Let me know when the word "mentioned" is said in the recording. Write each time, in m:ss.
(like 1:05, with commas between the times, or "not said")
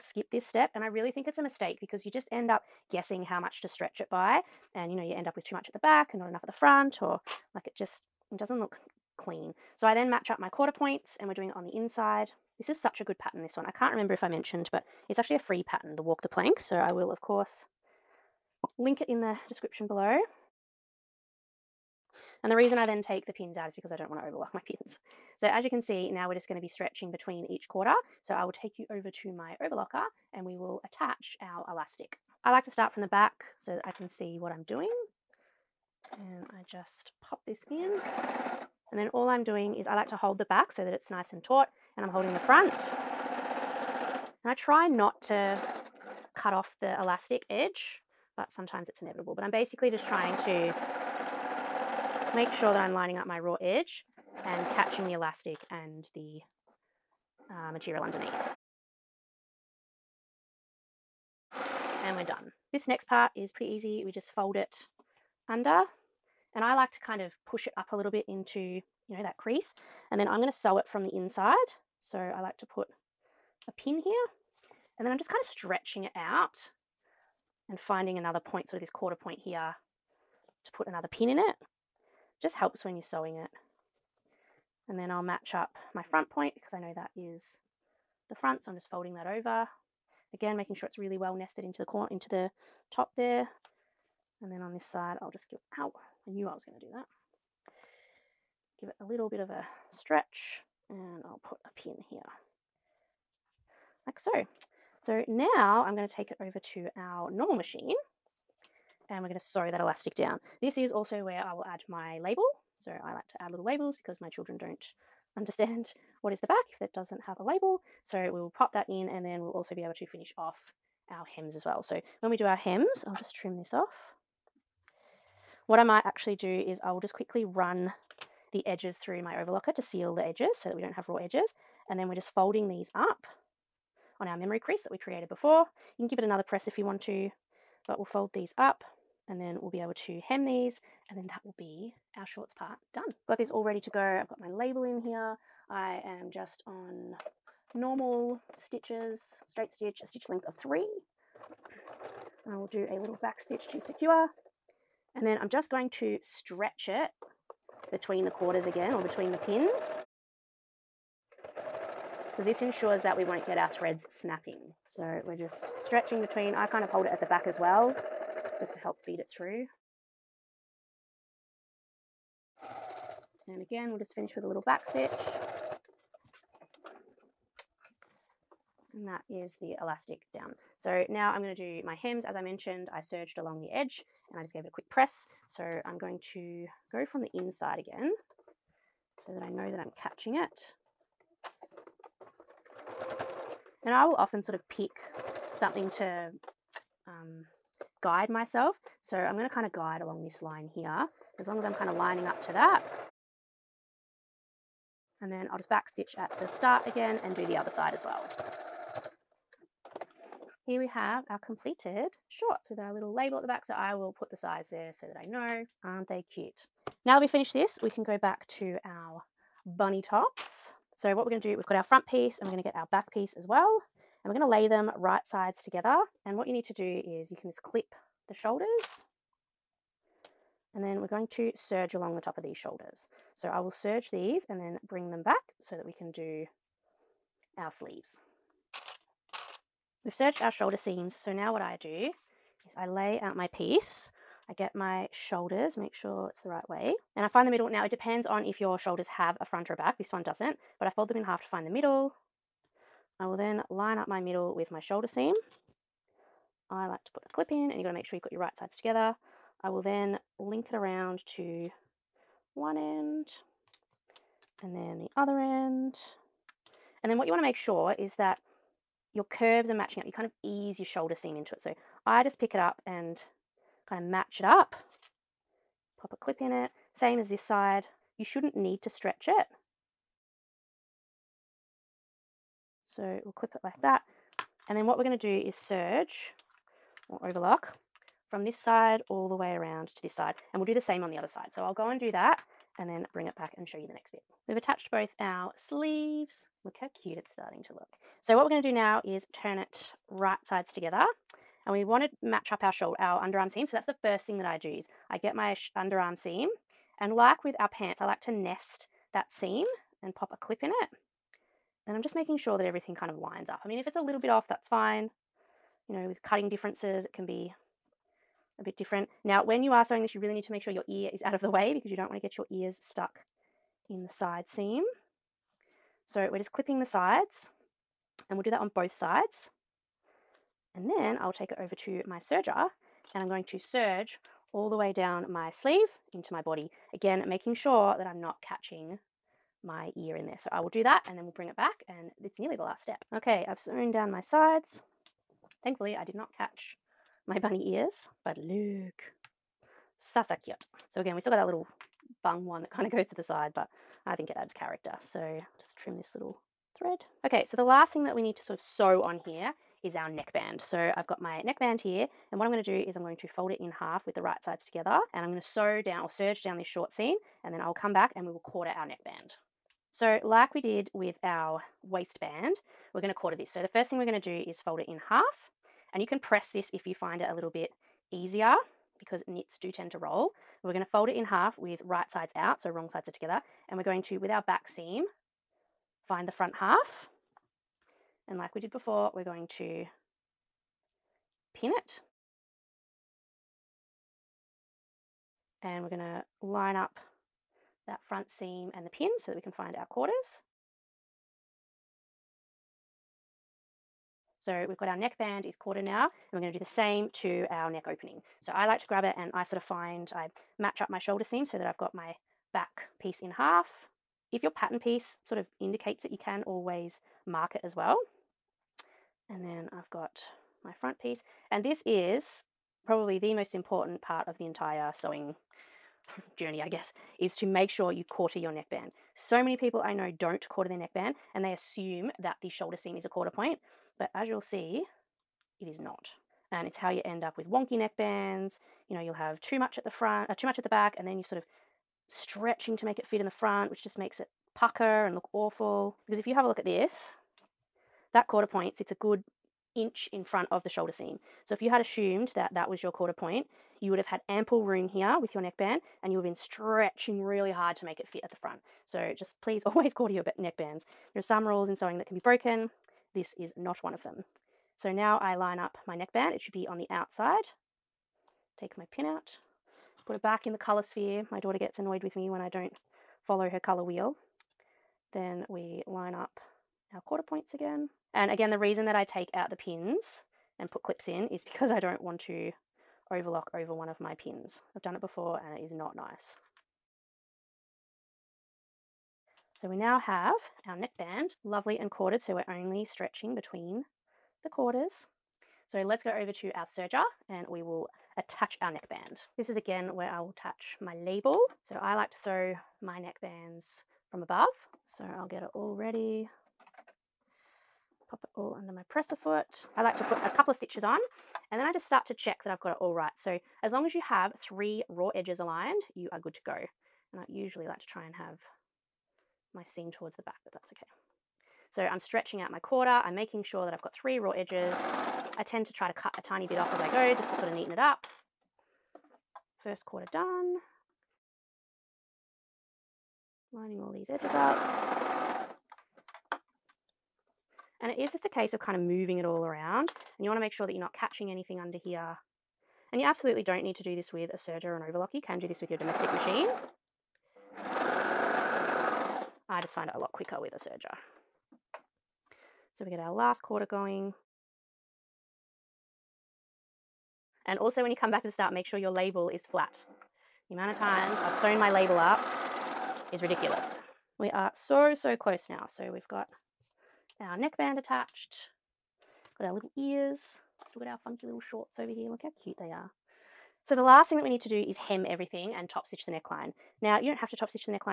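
0:14, 3:02.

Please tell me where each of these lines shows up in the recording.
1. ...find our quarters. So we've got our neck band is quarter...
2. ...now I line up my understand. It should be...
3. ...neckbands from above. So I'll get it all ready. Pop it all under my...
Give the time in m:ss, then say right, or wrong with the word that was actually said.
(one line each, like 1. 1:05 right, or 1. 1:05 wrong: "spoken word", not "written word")
1. 6:39 right
2. 7:44 wrong: "neckband", not "understand"
3. 8:22 right.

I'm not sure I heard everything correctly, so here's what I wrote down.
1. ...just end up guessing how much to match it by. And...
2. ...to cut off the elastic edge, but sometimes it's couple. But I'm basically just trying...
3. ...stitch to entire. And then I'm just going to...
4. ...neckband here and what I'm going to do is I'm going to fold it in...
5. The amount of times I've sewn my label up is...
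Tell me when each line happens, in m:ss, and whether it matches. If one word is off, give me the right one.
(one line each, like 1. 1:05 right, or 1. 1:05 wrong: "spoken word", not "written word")
1. 0:02 wrong: "stretch", not "match"
2. 0:45 wrong: "inevitable", not "couple"
3. 2:33 wrong: "secure", not "entire"
4. 6:01 right
5. 9:20 right.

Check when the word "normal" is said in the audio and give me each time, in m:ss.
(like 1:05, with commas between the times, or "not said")
1:47, 2:27.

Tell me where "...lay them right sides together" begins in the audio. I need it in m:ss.
3:44.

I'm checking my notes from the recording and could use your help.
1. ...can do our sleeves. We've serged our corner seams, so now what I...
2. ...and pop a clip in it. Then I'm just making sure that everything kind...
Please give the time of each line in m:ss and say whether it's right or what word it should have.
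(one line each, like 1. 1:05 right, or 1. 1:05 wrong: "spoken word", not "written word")
1. 3:55 wrong: "shoulder", not "corner"
2. 5:10 right.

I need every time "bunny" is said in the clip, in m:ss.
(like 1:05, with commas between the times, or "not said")
3:39, 5:47.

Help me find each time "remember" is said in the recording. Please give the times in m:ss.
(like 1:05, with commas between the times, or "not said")
0:13.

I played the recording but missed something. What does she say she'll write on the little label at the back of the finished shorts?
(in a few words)
the size.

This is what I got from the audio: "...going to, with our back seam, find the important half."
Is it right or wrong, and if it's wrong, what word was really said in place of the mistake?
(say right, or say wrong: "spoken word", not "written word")
wrong: "front", not "important".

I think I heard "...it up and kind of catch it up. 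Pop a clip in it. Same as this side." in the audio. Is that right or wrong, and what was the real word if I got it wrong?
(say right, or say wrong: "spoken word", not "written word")
wrong: "match", not "catch".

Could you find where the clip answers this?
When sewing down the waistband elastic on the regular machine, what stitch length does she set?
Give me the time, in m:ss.
2:30.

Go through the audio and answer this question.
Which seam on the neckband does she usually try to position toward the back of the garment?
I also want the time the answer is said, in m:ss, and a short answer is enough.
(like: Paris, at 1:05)
short seam, at 8:39.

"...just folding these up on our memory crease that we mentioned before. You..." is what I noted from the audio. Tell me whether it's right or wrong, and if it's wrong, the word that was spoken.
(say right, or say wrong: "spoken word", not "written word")
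wrong: "created", not "mentioned".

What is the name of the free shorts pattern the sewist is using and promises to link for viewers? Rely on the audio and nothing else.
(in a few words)
Walk the Plank.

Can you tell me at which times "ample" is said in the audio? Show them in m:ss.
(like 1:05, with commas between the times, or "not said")
7:34.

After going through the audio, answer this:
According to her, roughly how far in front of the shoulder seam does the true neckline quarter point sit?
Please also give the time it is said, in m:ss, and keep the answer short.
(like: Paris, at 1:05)
1 inch, at 7:28.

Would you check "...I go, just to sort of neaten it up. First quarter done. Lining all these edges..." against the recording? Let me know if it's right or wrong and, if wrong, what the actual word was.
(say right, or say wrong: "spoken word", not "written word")
right.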